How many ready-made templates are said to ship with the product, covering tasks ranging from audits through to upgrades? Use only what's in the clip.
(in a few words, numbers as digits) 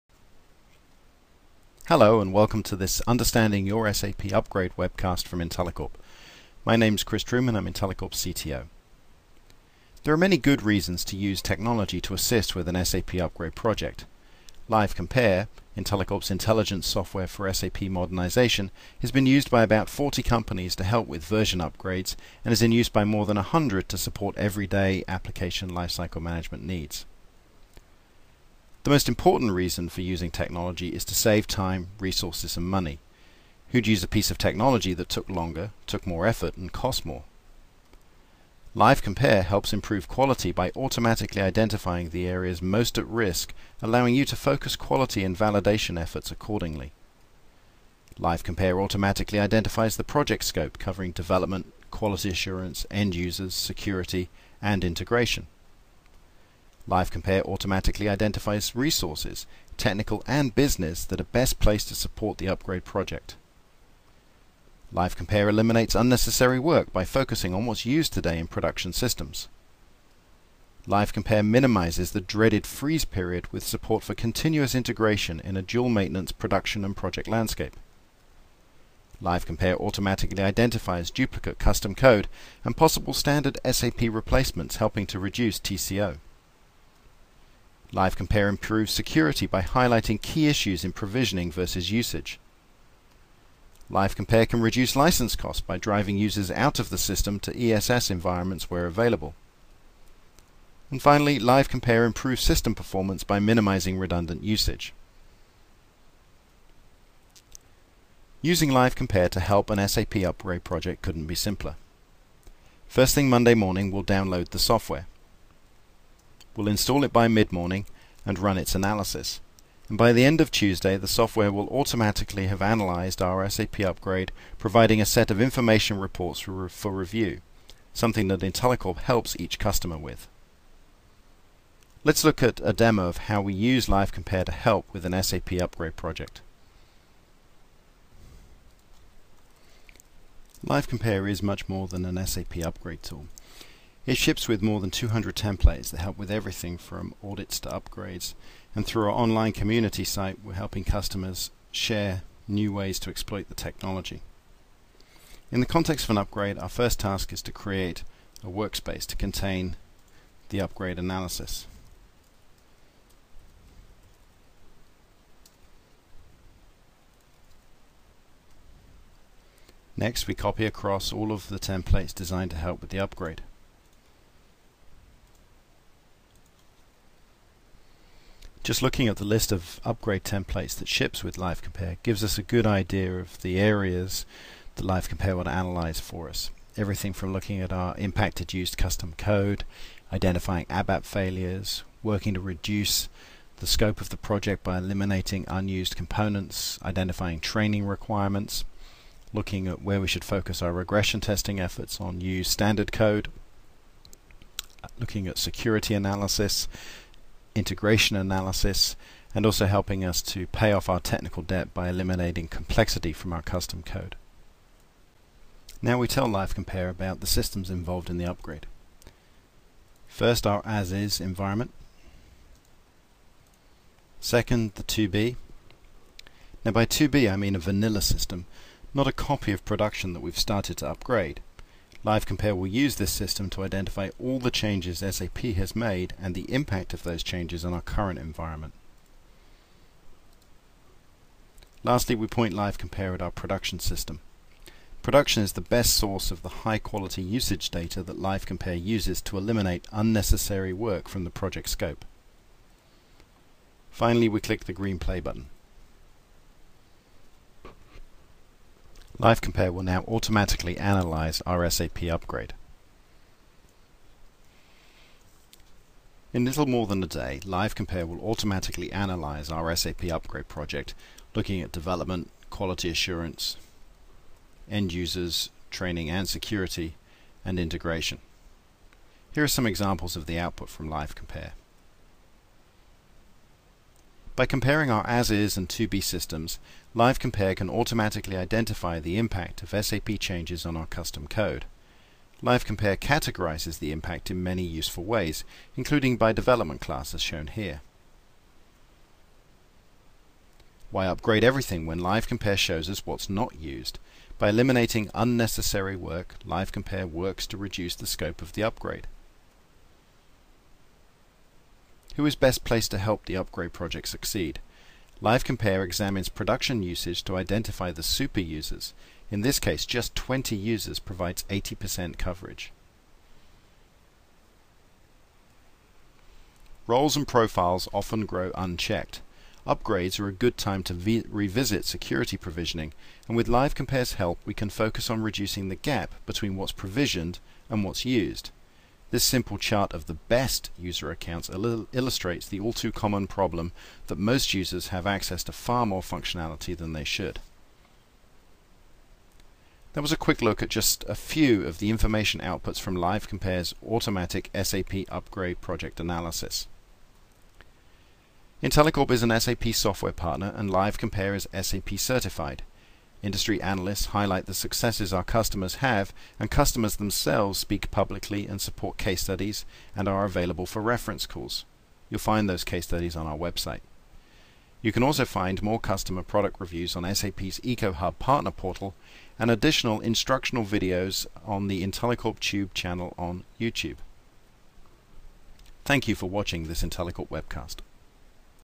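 200.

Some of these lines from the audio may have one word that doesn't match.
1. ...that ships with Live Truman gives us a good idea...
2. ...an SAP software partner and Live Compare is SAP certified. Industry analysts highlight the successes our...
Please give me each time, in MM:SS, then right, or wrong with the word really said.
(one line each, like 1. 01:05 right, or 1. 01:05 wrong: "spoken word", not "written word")
1. 03:00 wrong: "Compare", not "Truman"
2. 05:59 right.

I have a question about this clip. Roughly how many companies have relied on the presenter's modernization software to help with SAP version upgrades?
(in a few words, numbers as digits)
40.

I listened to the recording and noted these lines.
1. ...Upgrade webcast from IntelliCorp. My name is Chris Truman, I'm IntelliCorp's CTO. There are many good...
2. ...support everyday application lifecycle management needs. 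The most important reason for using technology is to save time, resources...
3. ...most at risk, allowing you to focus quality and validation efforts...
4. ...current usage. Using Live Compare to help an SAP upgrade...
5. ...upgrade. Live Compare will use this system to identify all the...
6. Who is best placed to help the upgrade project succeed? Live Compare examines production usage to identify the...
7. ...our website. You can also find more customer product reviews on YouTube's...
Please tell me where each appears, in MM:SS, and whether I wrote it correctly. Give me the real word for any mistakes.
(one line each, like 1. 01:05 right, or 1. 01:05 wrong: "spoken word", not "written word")
1. 00:04 right
2. 00:23 right
3. 00:42 right
4. 01:43 wrong: "redundant", not "current"
5. 03:50 right
6. 05:12 right
7. 06:13 wrong: "SAP", not "YouTube".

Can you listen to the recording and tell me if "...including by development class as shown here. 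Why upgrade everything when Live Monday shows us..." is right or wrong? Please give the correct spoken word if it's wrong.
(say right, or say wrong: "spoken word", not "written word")
wrong: "Compare", not "Monday".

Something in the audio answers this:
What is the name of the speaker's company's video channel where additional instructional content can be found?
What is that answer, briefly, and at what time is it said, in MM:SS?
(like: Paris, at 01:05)
IntelliCorp Tube, at 06:21.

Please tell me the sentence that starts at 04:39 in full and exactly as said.
Here are some examples of the output from LiveCompare.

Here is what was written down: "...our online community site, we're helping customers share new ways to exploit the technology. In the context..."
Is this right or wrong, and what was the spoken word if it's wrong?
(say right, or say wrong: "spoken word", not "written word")
right.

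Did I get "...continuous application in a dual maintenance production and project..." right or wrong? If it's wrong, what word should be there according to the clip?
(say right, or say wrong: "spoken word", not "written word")
wrong: "integration", not "application".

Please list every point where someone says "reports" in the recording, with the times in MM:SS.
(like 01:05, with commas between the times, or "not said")
02:05.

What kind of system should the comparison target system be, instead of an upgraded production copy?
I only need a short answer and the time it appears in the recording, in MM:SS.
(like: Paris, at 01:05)
A vanilla system, at 03:47.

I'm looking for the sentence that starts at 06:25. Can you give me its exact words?
Thank you for watching this IntelliCorp webcast.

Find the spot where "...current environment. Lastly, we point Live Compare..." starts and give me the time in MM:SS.
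03:57.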